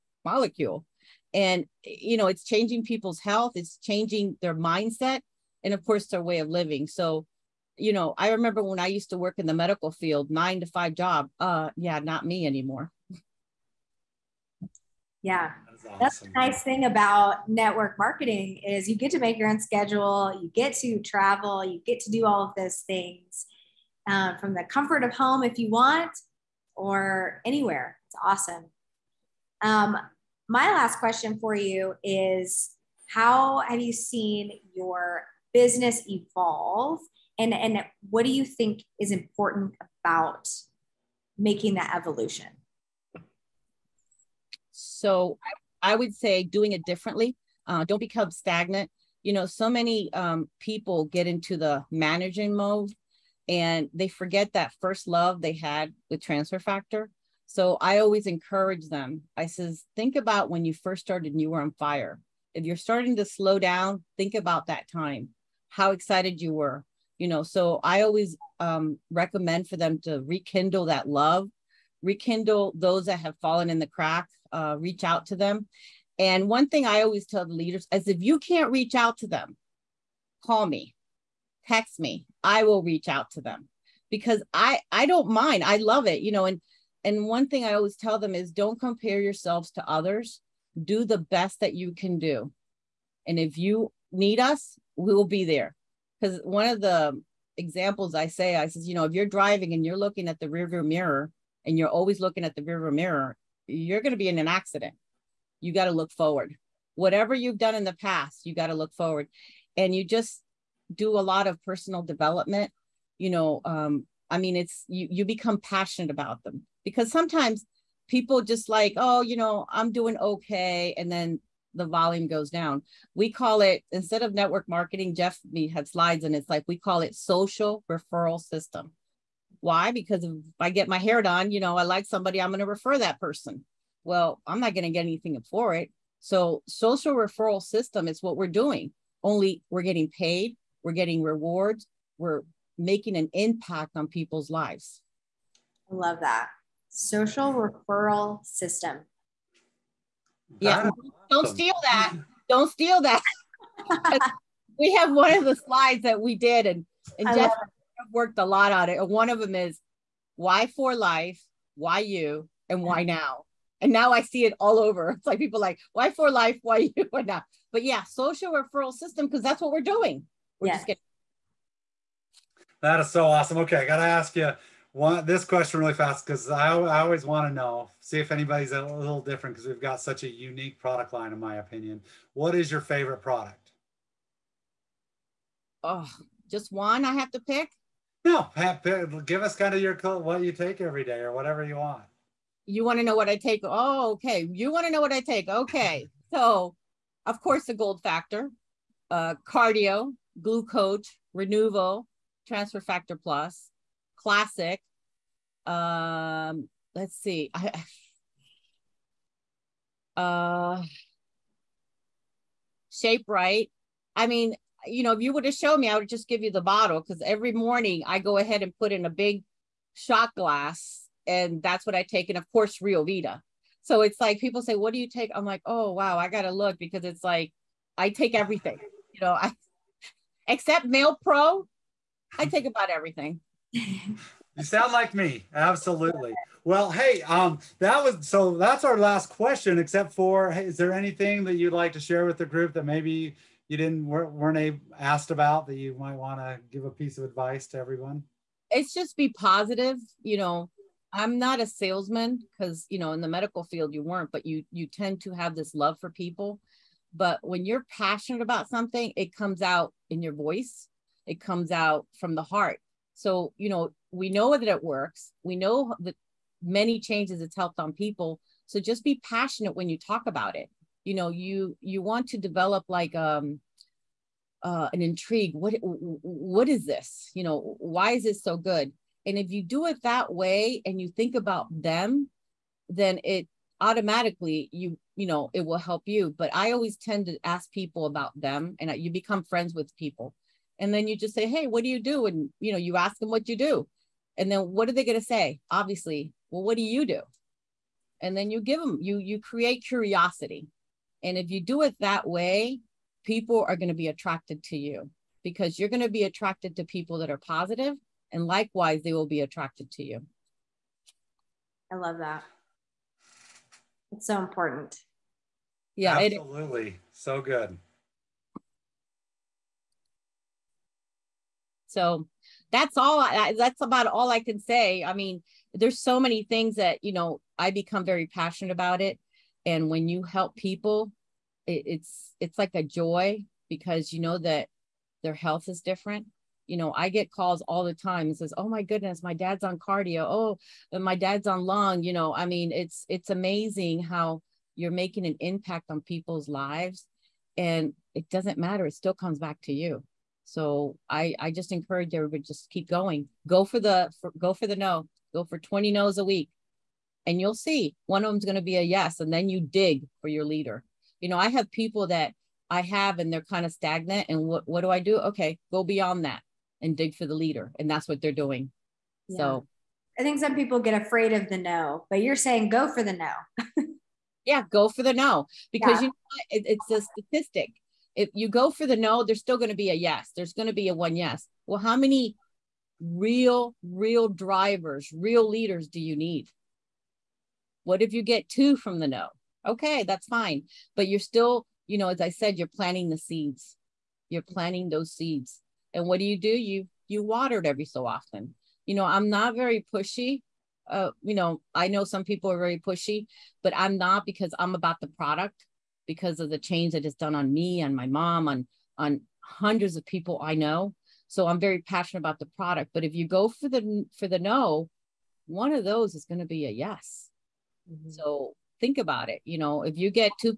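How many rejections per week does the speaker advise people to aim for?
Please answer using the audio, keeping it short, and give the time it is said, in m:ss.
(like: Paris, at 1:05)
20, at 5:55.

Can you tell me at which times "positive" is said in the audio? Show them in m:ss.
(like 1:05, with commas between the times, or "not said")
4:09, 5:07.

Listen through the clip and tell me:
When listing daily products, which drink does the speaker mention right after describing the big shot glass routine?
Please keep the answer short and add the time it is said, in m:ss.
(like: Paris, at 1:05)
RioVida, at 3:42.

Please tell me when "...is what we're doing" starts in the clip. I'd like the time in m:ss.
2:18.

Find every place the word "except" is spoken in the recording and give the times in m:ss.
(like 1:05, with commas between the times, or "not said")
3:50, 3:59.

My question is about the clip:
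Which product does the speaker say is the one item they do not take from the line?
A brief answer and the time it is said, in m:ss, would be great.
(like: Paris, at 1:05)
MalePro, at 3:50.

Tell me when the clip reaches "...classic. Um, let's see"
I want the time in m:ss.
3:24.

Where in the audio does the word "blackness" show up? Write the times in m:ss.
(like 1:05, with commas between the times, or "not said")
not said.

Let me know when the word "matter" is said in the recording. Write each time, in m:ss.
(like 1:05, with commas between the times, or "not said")
5:48.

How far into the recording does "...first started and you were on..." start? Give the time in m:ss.
1:00.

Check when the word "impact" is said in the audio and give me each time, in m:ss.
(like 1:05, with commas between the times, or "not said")
2:23, 5:45.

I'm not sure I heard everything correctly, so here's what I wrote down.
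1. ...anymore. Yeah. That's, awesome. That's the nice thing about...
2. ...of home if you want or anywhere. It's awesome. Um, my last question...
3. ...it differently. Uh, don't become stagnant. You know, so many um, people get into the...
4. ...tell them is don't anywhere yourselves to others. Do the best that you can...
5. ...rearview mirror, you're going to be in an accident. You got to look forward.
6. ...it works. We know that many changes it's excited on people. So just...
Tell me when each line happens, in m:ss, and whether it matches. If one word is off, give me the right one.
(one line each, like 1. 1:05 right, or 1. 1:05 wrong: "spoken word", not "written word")
1. 0:12 right
2. 0:25 right
3. 0:46 right
4. 1:27 wrong: "compare", not "anywhere"
5. 1:42 right
6. 4:24 wrong: "helped", not "excited".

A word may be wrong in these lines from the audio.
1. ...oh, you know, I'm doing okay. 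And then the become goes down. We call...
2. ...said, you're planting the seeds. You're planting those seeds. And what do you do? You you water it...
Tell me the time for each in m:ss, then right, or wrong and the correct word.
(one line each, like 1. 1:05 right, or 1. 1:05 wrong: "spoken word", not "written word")
1. 1:58 wrong: "volume", not "become"
2. 6:32 right.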